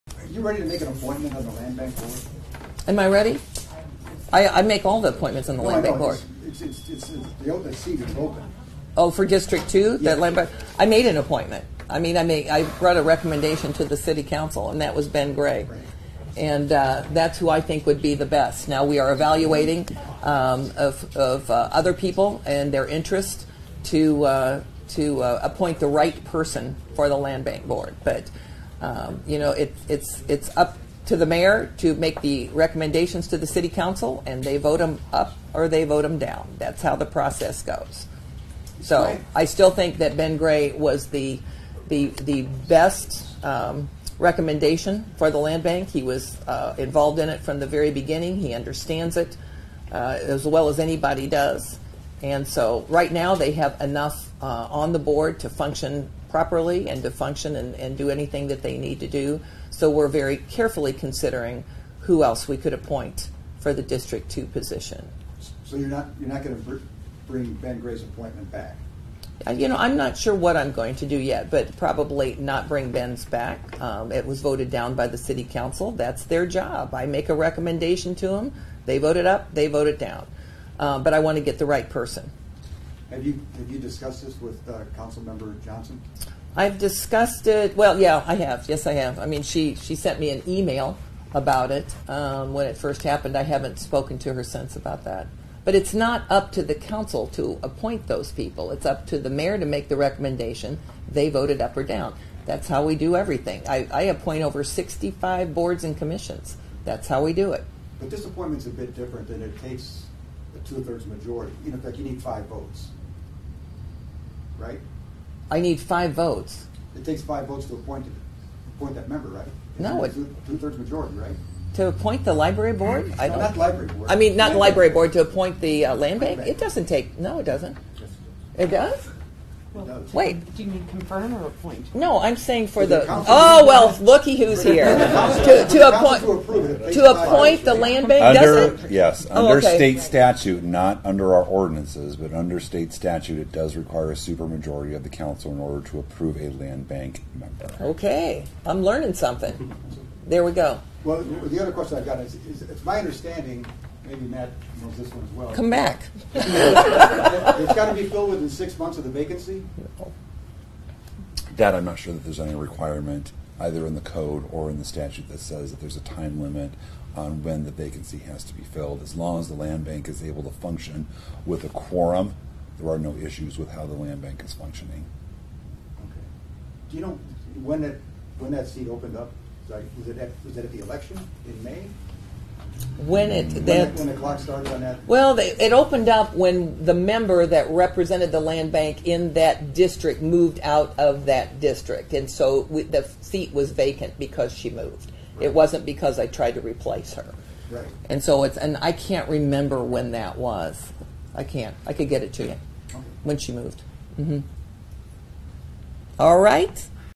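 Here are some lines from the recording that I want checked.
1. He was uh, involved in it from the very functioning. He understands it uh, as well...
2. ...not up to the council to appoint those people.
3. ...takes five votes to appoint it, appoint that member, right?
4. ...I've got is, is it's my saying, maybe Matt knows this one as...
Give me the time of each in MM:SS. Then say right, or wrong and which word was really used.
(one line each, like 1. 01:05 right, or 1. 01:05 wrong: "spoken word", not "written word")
1. 00:45 wrong: "beginning", not "functioning"
2. 01:35 right
3. 01:57 right
4. 02:31 wrong: "understanding", not "saying".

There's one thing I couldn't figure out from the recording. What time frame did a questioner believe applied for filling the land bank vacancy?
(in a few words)
6 months.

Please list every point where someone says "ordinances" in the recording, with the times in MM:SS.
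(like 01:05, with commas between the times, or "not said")
02:21.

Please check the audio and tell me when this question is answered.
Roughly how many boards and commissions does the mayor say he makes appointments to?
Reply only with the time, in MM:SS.
01:44.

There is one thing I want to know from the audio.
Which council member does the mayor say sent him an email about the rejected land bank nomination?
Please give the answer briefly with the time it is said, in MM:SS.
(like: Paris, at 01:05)
Member Johnson, at 01:25.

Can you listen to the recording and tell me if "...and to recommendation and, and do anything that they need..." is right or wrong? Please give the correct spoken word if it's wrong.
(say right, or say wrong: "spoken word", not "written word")
wrong: "function", not "recommendation".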